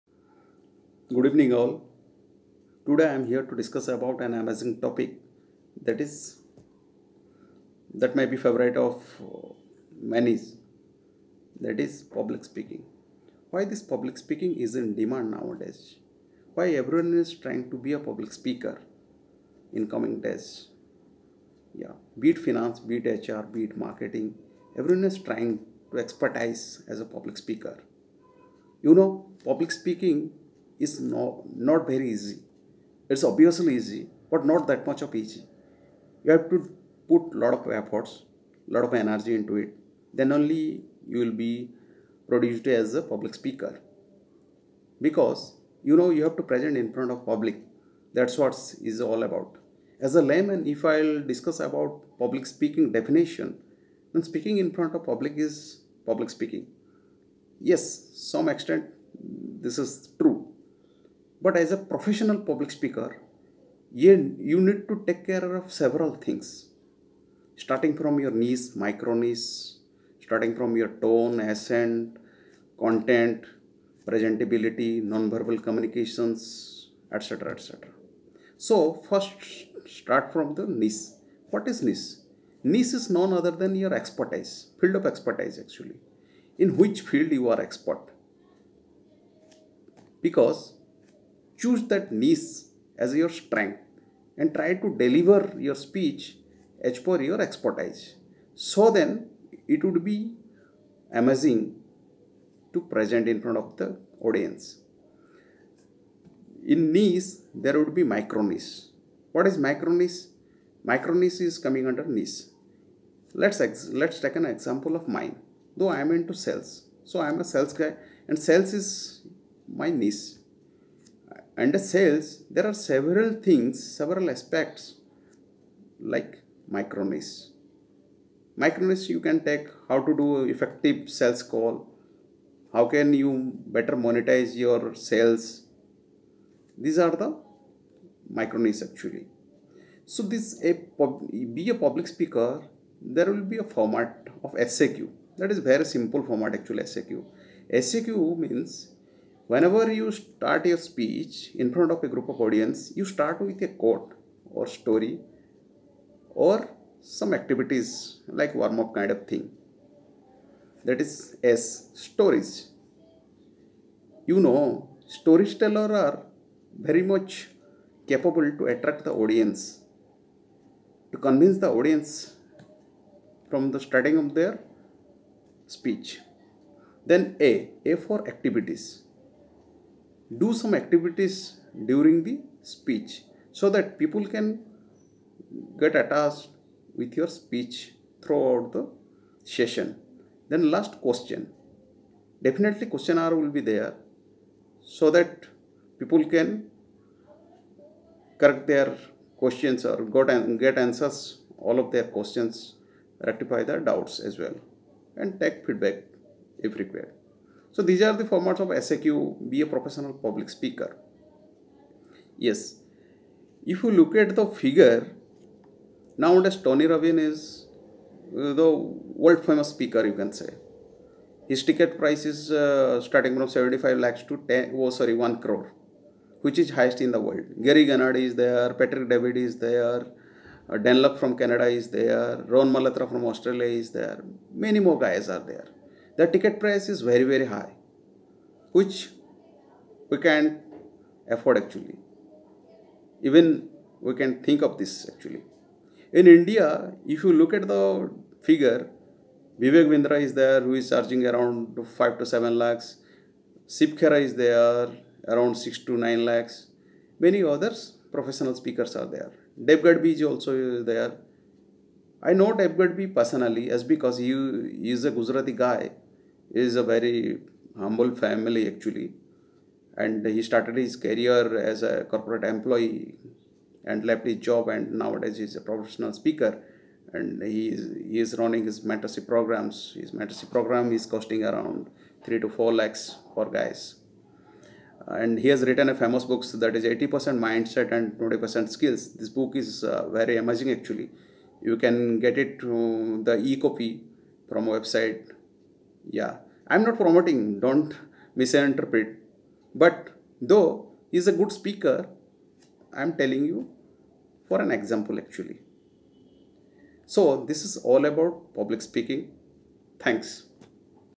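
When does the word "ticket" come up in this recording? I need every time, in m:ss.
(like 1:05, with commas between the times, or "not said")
3:41, 3:56.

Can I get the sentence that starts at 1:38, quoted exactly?
So then it would be amazing to present in front of the audience.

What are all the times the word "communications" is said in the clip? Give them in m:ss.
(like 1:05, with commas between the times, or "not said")
1:15.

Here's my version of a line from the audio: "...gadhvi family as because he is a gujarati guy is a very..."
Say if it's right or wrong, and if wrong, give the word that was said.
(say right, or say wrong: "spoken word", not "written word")
wrong: "personally", not "family".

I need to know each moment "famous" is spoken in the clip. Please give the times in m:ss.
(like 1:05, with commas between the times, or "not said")
3:39, 4:45.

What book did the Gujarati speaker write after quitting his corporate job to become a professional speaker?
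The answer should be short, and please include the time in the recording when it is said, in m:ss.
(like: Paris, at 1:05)
80% mindset and 20% skills, at 4:46.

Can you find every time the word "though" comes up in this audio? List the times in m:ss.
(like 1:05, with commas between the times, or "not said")
1:55, 5:00.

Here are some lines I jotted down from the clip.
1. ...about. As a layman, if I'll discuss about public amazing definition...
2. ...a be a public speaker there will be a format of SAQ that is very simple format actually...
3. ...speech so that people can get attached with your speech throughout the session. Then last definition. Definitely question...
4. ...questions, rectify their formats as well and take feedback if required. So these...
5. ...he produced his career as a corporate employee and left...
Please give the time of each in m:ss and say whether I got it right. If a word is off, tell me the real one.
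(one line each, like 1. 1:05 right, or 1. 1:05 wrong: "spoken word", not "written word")
1. 0:49 wrong: "speaking", not "amazing"
2. 2:20 right
3. 3:02 wrong: "question", not "definition"
4. 3:22 wrong: "doubts", not "formats"
5. 4:30 wrong: "started", not "produced".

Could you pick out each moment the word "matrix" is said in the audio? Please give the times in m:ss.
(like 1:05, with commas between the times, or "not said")
not said.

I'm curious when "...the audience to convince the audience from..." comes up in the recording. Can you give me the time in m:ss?
2:49.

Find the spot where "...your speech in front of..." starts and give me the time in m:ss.
2:30.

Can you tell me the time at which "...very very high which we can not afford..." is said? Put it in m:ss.
3:57.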